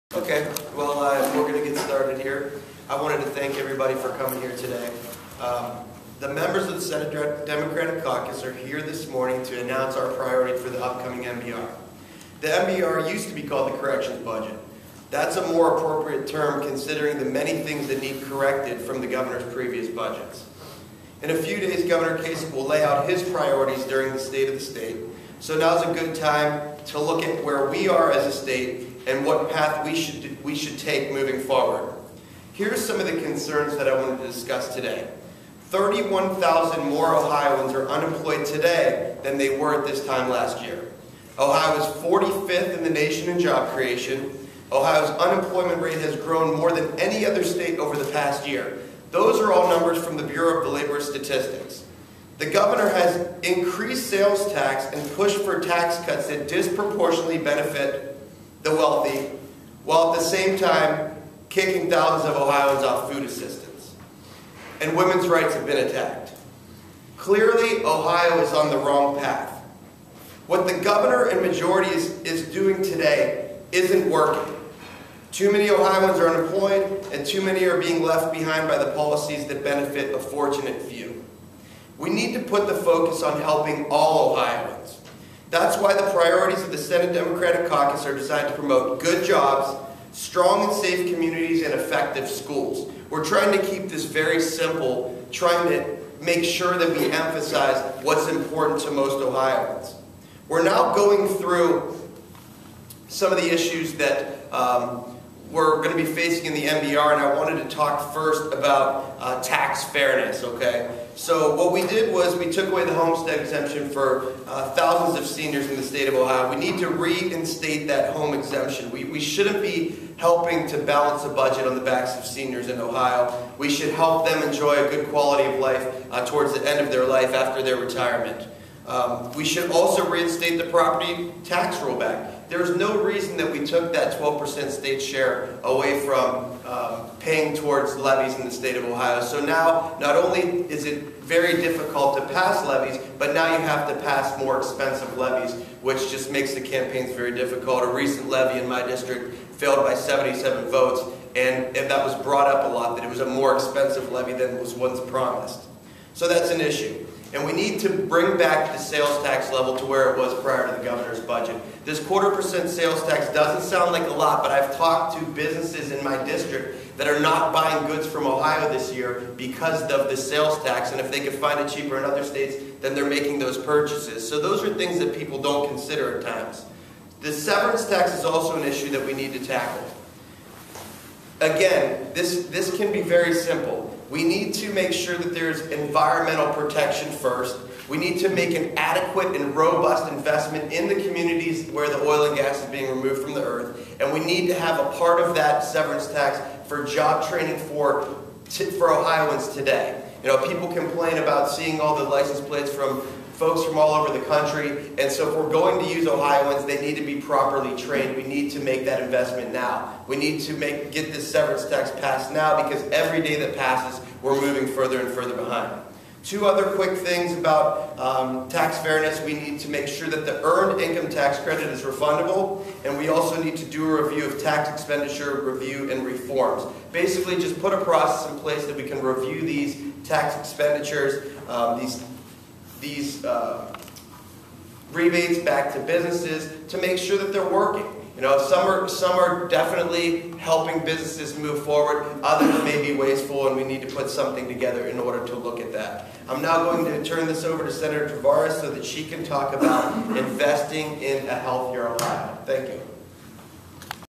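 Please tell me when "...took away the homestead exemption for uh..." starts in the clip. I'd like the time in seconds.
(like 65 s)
112 s.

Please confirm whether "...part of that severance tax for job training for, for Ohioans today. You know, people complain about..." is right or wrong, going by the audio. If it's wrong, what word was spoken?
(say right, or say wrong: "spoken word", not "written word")
right.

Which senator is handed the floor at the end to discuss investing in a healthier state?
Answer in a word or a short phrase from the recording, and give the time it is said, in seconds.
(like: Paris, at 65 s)
Senator Tavares, at 247 s.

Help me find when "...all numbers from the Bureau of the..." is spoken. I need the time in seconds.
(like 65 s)
49 s.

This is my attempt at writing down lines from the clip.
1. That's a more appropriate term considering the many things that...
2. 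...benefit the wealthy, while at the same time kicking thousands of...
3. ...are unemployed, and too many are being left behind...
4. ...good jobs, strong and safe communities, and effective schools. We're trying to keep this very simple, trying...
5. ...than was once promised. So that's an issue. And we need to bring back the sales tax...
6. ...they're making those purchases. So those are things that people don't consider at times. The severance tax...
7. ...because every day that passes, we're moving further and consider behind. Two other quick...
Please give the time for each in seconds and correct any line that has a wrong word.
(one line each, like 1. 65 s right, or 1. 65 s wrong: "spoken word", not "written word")
1. 15 s right
2. 57 s right
3. 76 s right
4. 89 s right
5. 154 s right
6. 172 s right
7. 212 s wrong: "further", not "consider".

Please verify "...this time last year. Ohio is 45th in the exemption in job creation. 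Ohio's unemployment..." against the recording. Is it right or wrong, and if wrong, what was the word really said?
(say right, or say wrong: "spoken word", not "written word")
wrong: "nation", not "exemption".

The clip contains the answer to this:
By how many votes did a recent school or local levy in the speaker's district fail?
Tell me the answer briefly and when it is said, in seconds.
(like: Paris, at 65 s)
77, at 149 s.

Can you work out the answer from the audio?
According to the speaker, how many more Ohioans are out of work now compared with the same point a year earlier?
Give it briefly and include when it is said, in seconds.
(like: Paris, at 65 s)
31,000, at 35 s.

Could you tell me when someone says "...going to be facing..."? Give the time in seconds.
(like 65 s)
105 s.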